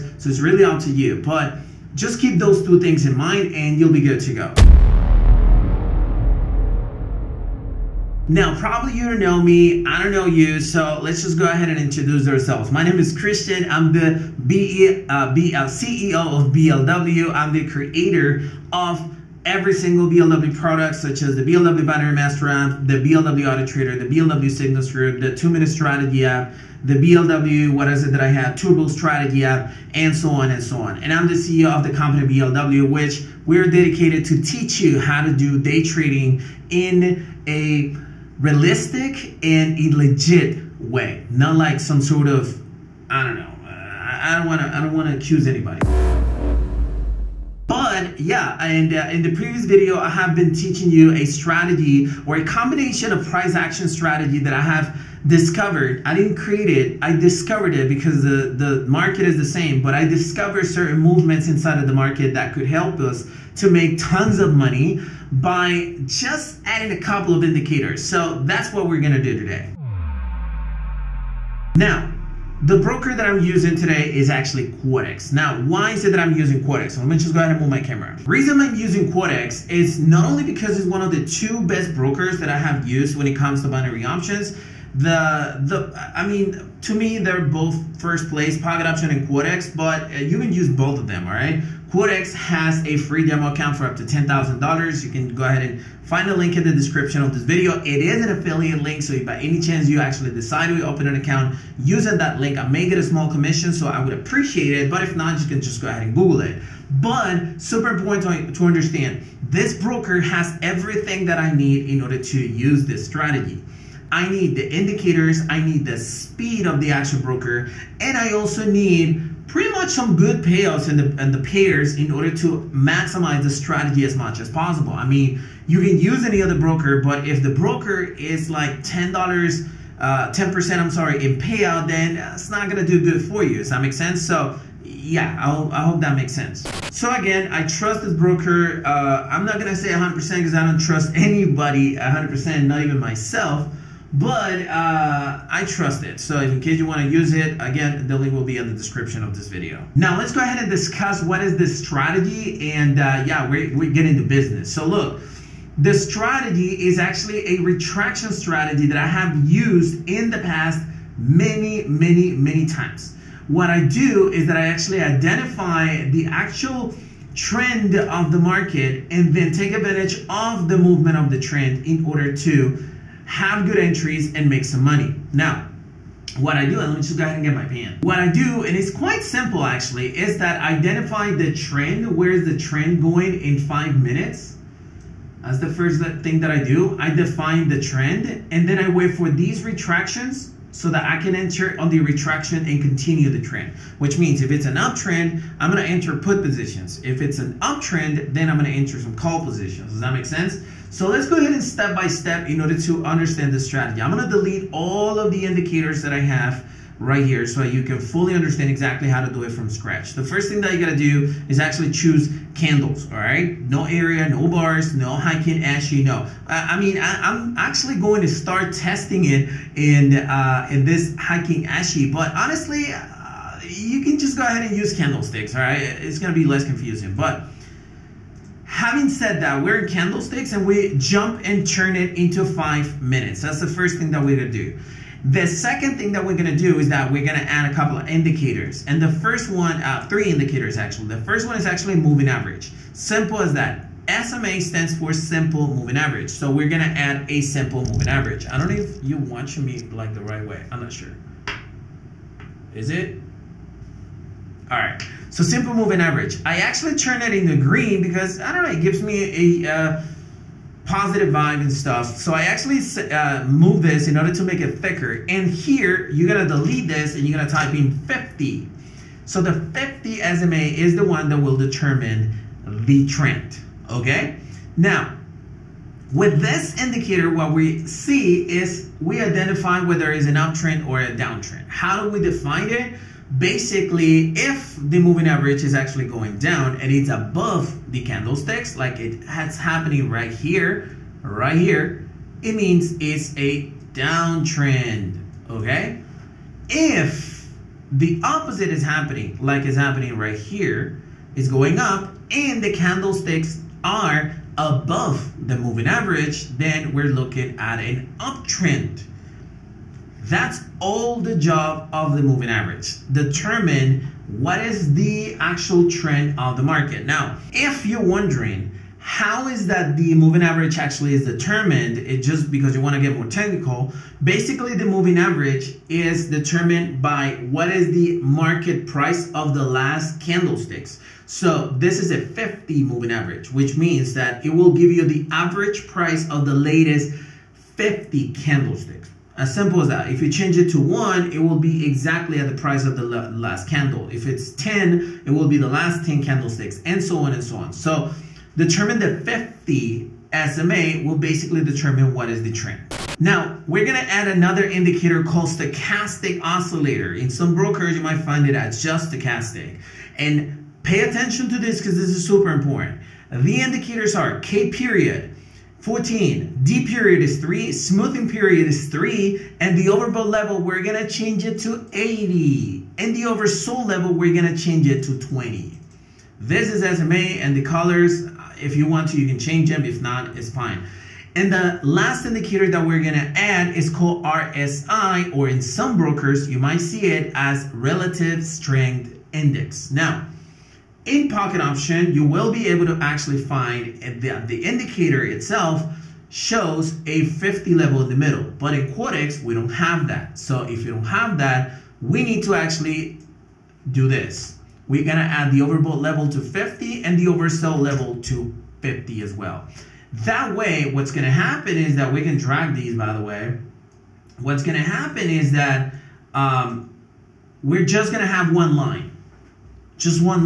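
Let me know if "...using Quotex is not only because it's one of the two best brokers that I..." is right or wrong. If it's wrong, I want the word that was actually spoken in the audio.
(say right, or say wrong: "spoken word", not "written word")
right.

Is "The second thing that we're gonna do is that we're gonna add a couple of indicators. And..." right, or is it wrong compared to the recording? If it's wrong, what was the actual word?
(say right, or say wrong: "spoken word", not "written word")
right.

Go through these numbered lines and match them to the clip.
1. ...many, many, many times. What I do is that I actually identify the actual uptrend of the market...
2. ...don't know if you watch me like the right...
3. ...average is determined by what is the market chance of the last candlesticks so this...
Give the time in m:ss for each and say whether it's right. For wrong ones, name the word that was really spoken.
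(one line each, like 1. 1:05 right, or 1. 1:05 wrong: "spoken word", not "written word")
1. 2:41 wrong: "trend", not "uptrend"
2. 4:08 right
3. 5:25 wrong: "price", not "chance".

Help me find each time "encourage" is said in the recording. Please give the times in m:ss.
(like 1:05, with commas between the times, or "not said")
not said.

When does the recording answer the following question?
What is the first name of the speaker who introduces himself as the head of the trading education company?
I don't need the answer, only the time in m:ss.
0:13.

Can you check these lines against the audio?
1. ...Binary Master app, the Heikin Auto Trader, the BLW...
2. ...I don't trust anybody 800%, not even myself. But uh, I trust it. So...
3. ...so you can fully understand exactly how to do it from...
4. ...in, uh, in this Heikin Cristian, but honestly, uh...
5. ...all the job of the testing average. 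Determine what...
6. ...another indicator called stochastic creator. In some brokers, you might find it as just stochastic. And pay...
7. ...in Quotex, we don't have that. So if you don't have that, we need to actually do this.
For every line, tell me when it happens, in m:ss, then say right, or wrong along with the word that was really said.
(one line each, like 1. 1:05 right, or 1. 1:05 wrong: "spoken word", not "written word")
1. 0:21 wrong: "BLW", not "Heikin"
2. 2:20 wrong: "100", not "800"
3. 3:27 right
4. 3:39 wrong: "Ashi", not "Cristian"
5. 5:10 wrong: "moving", not "testing"
6. 5:54 wrong: "oscillator", not "creator"
7. 6:38 right.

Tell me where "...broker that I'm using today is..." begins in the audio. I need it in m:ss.
1:12.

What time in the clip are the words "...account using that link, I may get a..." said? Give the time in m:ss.
1:41.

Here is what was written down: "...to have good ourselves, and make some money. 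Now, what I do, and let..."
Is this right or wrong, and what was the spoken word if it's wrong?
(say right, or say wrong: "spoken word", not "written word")
wrong: "entries", not "ourselves".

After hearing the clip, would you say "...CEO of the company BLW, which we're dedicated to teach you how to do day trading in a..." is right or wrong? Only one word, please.
right.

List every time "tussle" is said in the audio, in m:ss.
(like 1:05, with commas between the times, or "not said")
not said.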